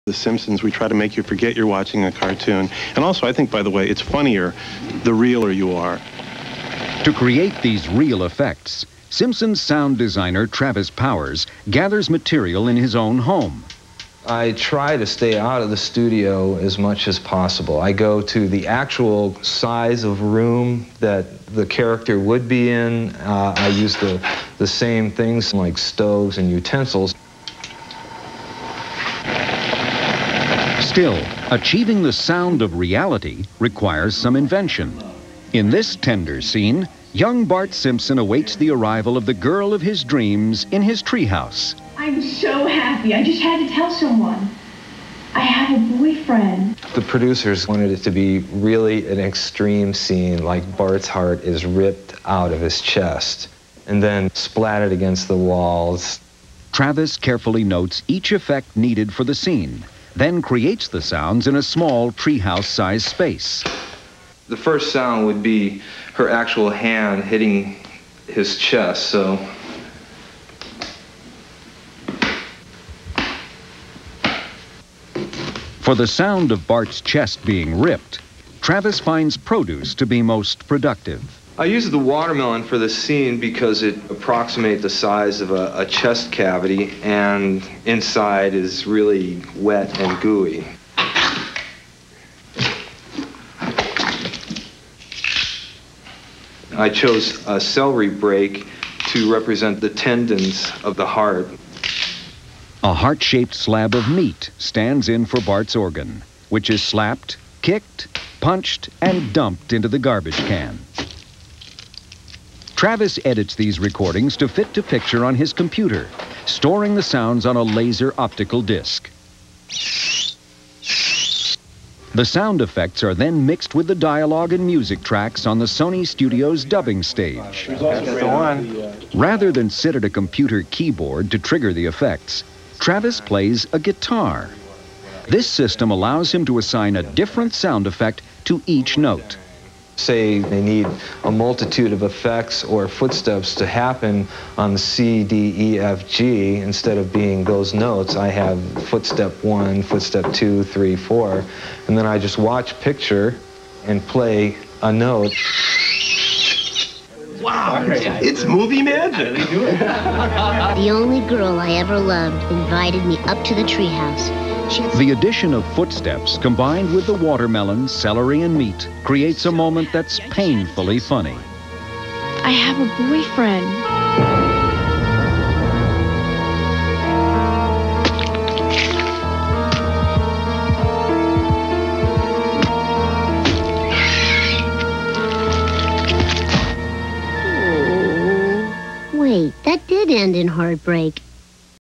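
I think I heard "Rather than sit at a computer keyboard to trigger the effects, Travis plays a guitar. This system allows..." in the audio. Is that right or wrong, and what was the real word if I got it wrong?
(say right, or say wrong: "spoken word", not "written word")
right.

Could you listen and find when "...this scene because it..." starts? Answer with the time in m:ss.
1:22.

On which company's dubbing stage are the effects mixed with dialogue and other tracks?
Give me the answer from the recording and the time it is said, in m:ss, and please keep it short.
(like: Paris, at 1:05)
Sony Studios, at 2:05.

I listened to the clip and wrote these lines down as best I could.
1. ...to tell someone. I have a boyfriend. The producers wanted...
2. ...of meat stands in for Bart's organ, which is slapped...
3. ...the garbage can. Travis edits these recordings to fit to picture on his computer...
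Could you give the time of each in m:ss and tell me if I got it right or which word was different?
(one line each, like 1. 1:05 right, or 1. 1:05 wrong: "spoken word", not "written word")
1. 0:43 right
2. 1:43 right
3. 1:49 right.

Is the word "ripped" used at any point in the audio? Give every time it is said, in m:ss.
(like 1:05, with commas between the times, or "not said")
0:51, 1:17.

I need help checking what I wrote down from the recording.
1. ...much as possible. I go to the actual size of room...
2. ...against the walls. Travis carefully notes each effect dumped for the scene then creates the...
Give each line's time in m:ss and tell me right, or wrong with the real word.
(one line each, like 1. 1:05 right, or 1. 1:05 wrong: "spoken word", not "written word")
1. 0:16 right
2. 0:54 wrong: "needed", not "dumped".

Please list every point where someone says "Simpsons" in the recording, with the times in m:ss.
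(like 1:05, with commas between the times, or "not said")
0:00, 0:09, 0:37.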